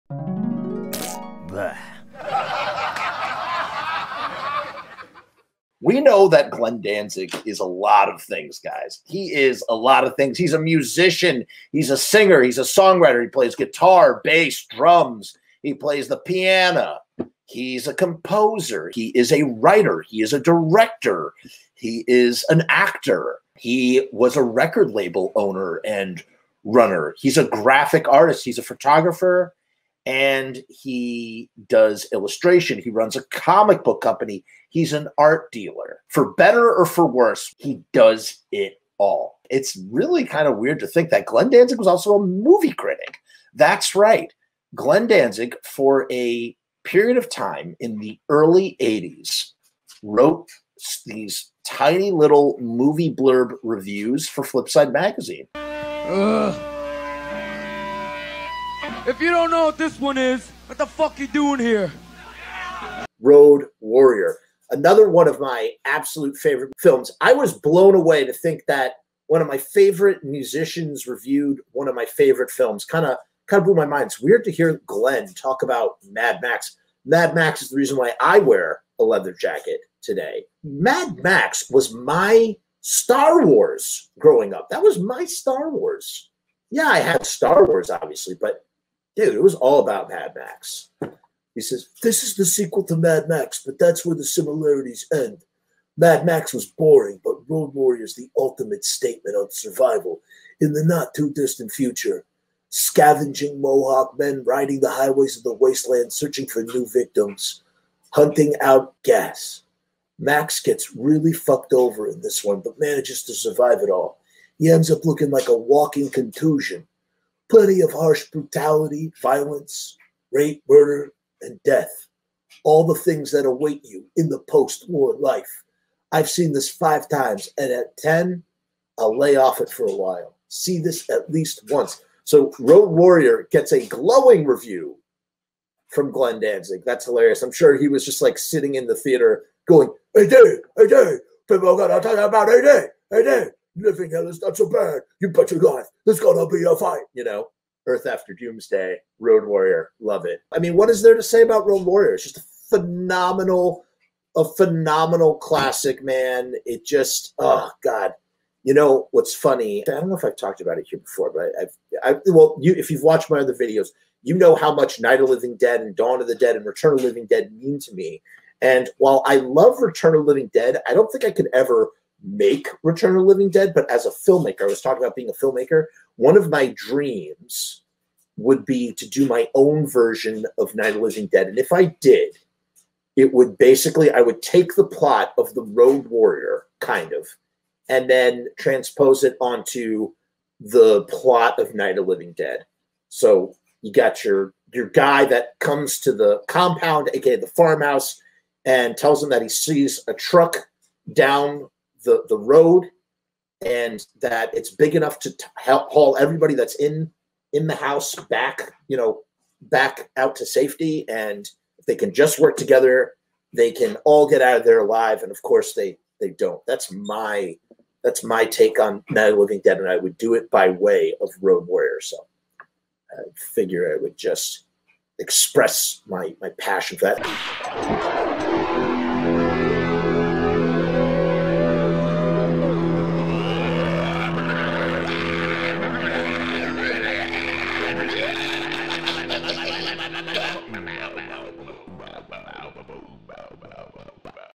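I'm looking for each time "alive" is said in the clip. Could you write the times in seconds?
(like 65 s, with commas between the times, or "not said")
214 s.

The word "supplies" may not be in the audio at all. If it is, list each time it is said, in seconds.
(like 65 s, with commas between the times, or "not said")
not said.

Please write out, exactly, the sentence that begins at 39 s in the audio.
It's really kind of weird to think that Glenn Danzig was also a movie critic.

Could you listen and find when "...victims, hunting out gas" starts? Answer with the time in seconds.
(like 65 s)
106 s.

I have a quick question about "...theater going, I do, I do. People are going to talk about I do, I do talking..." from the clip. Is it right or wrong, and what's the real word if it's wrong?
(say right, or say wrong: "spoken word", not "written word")
wrong: "living", not "talking".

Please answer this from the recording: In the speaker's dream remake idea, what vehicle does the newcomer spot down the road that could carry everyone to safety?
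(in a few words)
A truck.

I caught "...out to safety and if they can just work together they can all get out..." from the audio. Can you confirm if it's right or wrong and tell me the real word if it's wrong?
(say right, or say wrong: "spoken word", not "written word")
right.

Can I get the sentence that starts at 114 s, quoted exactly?
He ends up looking like a walking contusion plenty of harsh brutality, violence, rape, murder, and death.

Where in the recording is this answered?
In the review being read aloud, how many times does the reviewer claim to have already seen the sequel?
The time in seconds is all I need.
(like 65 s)
126 s.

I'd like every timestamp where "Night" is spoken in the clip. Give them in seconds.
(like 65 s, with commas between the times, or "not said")
164 s, 180 s, 191 s, 219 s.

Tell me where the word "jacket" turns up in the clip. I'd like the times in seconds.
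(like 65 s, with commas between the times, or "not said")
79 s.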